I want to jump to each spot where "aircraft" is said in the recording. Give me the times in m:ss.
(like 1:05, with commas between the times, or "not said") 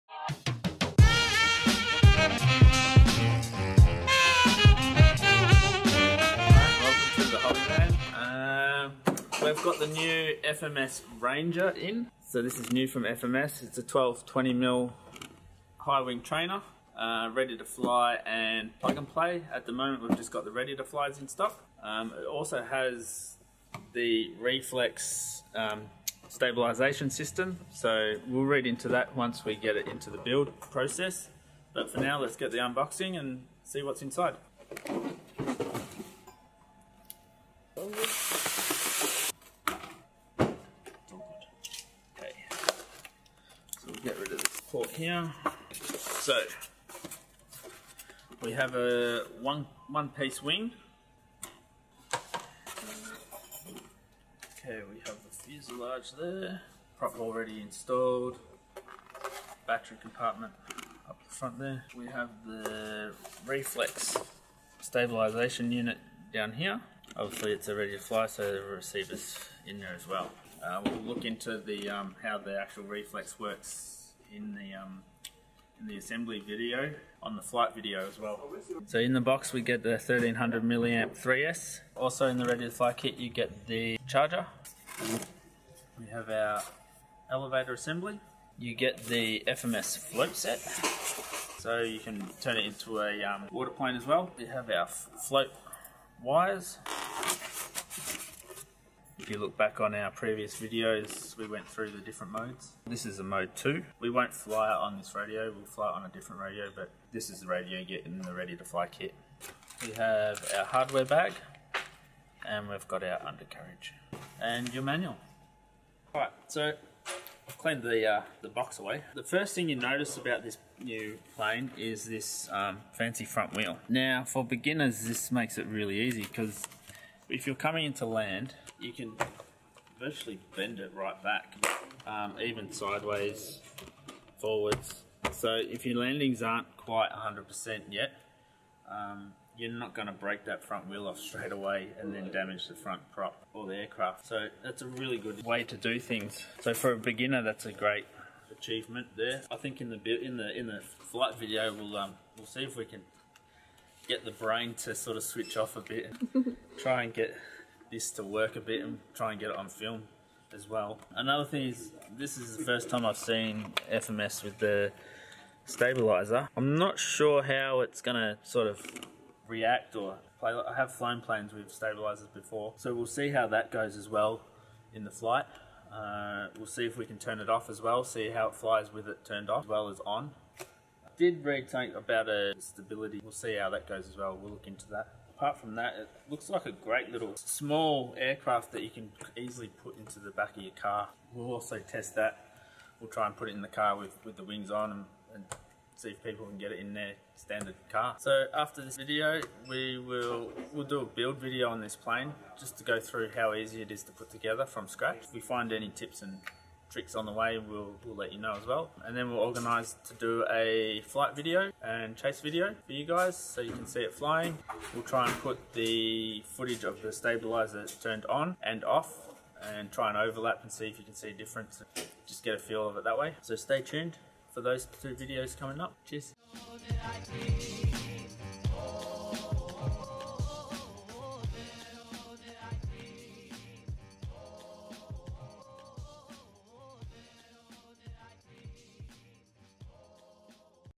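2:23, 3:08.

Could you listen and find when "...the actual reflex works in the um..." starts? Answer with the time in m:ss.
1:12.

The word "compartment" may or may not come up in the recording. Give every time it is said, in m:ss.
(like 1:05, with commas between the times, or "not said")
1:00.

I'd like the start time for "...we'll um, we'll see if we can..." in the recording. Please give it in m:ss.
2:31.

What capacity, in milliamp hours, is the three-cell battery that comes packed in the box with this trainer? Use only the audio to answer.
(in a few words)
1300.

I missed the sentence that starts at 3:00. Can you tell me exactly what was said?
I did read something about a stability.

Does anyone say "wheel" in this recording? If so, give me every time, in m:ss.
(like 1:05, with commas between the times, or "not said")
2:03, 2:20.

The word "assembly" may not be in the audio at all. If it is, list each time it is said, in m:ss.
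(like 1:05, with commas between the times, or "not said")
1:15, 1:27.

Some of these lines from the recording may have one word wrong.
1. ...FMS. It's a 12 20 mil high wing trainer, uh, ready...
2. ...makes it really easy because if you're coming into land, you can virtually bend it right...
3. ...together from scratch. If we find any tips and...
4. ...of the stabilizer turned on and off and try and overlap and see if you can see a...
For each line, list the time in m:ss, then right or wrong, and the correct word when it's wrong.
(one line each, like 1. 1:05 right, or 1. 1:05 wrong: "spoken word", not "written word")
1. 0:13 right
2. 2:05 right
3. 3:24 right
4. 3:36 right.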